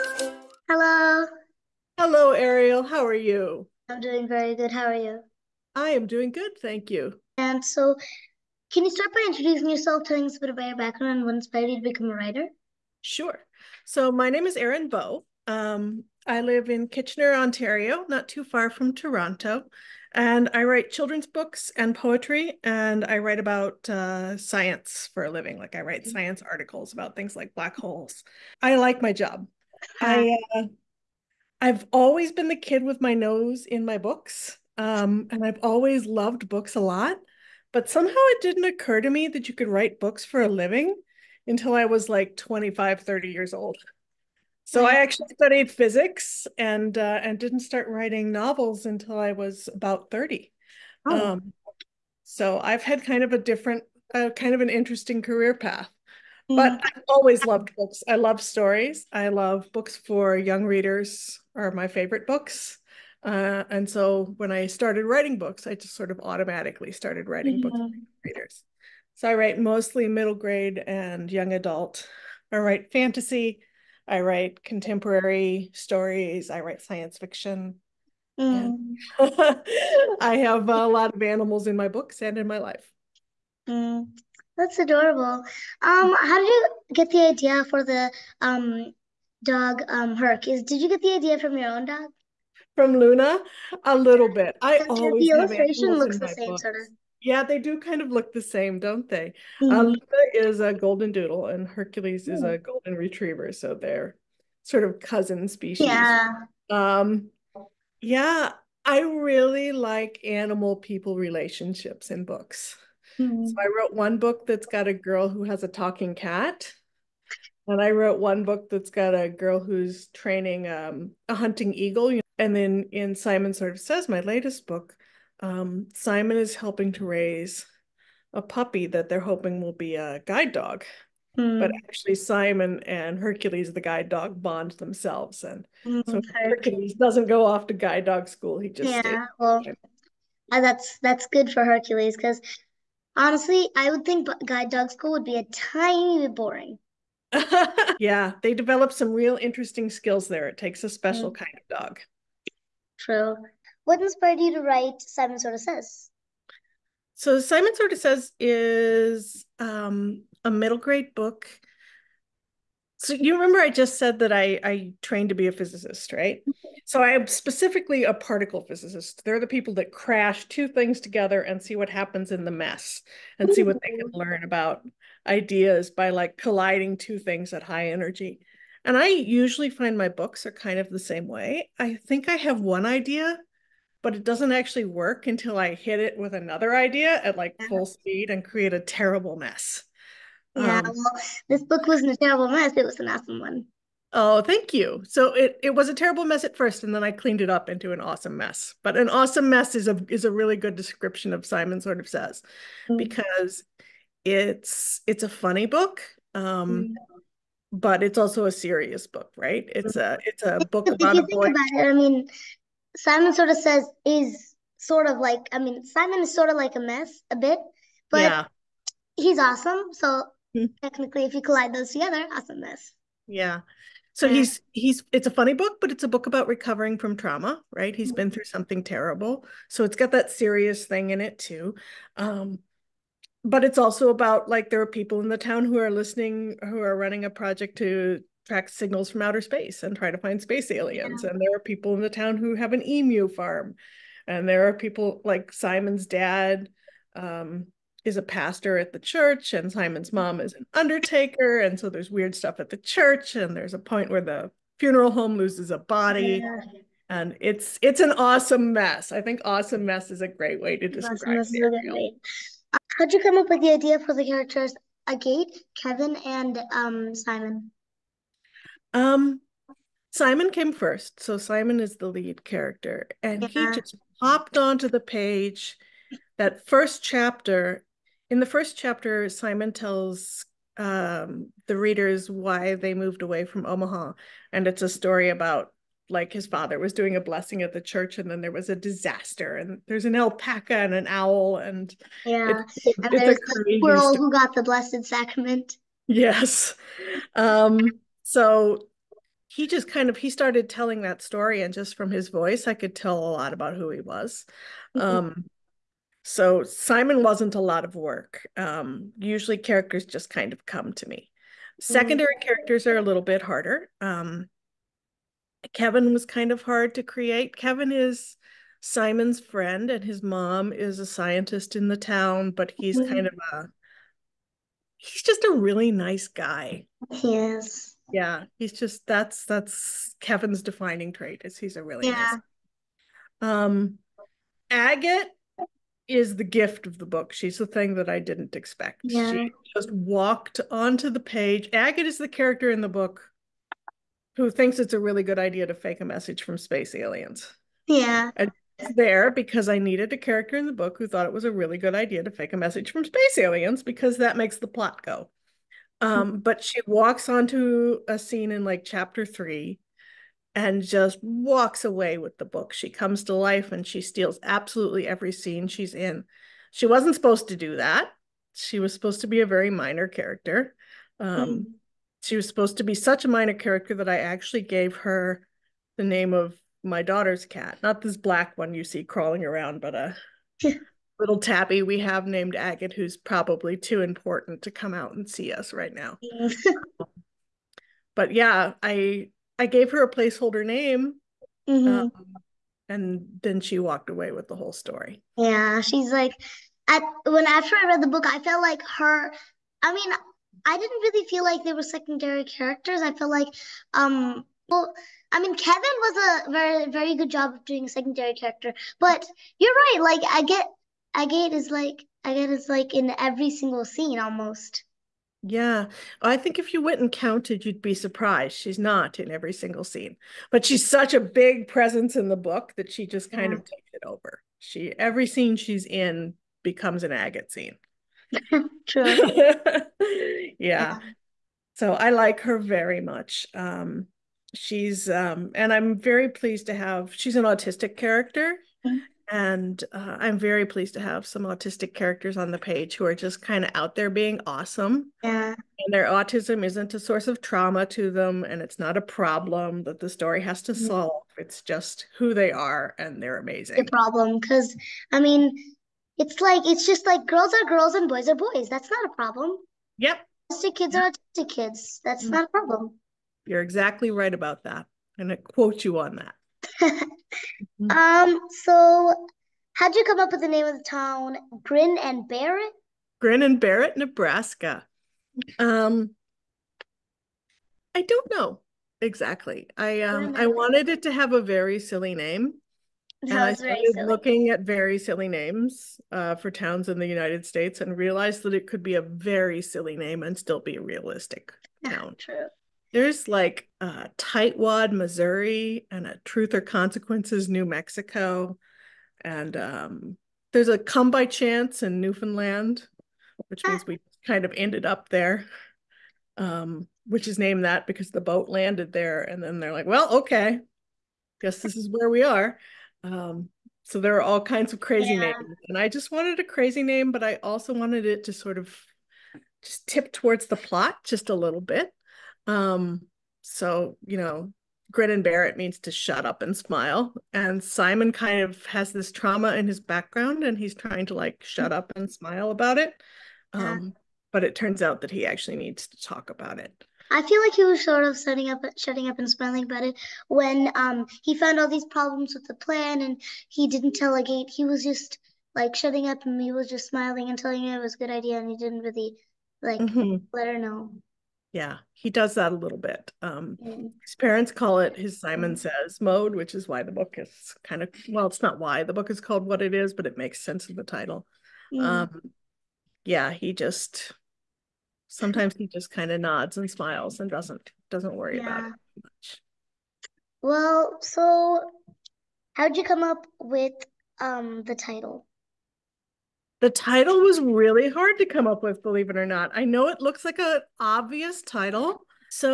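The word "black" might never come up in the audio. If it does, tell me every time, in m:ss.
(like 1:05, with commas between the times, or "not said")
0:27, 6:18.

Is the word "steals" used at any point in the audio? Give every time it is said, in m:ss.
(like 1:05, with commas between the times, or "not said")
6:03.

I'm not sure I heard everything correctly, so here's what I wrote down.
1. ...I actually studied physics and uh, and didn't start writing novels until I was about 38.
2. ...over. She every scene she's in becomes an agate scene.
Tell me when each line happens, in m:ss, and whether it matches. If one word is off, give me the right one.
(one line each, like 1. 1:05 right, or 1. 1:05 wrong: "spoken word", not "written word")
1. 0:44 wrong: "30", not "38"
2. 7:04 right.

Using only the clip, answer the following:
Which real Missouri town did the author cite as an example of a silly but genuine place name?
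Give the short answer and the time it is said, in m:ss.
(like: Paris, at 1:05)
Tightwad, at 8:13.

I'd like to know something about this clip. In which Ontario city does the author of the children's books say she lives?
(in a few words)
Kitchener.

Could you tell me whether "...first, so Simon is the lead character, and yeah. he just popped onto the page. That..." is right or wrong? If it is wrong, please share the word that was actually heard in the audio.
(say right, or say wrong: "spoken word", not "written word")
right.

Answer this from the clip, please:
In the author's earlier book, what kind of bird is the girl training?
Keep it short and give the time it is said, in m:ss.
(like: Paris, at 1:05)
Hunting eagle, at 2:01.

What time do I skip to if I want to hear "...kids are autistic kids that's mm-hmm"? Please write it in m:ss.
7:40.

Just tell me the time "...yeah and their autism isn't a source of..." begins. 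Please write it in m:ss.
7:25.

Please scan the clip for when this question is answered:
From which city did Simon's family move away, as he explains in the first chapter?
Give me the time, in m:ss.
4:43.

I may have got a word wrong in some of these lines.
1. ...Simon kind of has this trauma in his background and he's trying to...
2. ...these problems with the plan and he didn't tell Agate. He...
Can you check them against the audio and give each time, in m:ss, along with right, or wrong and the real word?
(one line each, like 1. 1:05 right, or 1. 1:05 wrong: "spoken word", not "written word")
1. 8:47 right
2. 9:01 right.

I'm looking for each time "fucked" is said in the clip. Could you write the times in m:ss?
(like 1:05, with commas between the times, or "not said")
not said.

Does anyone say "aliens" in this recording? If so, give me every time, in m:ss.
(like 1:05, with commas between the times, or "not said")
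4:00, 5:46, 5:53.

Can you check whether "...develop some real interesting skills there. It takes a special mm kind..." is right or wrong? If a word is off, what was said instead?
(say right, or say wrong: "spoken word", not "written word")
right.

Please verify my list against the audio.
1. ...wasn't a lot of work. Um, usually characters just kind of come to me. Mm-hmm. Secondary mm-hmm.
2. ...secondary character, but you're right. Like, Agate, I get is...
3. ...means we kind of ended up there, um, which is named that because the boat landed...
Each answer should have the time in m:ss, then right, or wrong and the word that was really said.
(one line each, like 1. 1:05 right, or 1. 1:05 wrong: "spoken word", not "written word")
1. 5:07 right
2. 6:47 right
3. 8:23 right.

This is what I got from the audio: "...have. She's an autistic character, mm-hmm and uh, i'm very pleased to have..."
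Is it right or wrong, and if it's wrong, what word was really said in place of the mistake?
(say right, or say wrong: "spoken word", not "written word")
right.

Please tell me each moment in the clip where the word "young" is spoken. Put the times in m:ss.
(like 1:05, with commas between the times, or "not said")
1:00, 1:11.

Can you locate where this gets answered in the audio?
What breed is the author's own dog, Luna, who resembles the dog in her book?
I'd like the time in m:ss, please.
1:40.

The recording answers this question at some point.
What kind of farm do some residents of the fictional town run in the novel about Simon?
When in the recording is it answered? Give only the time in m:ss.
4:02.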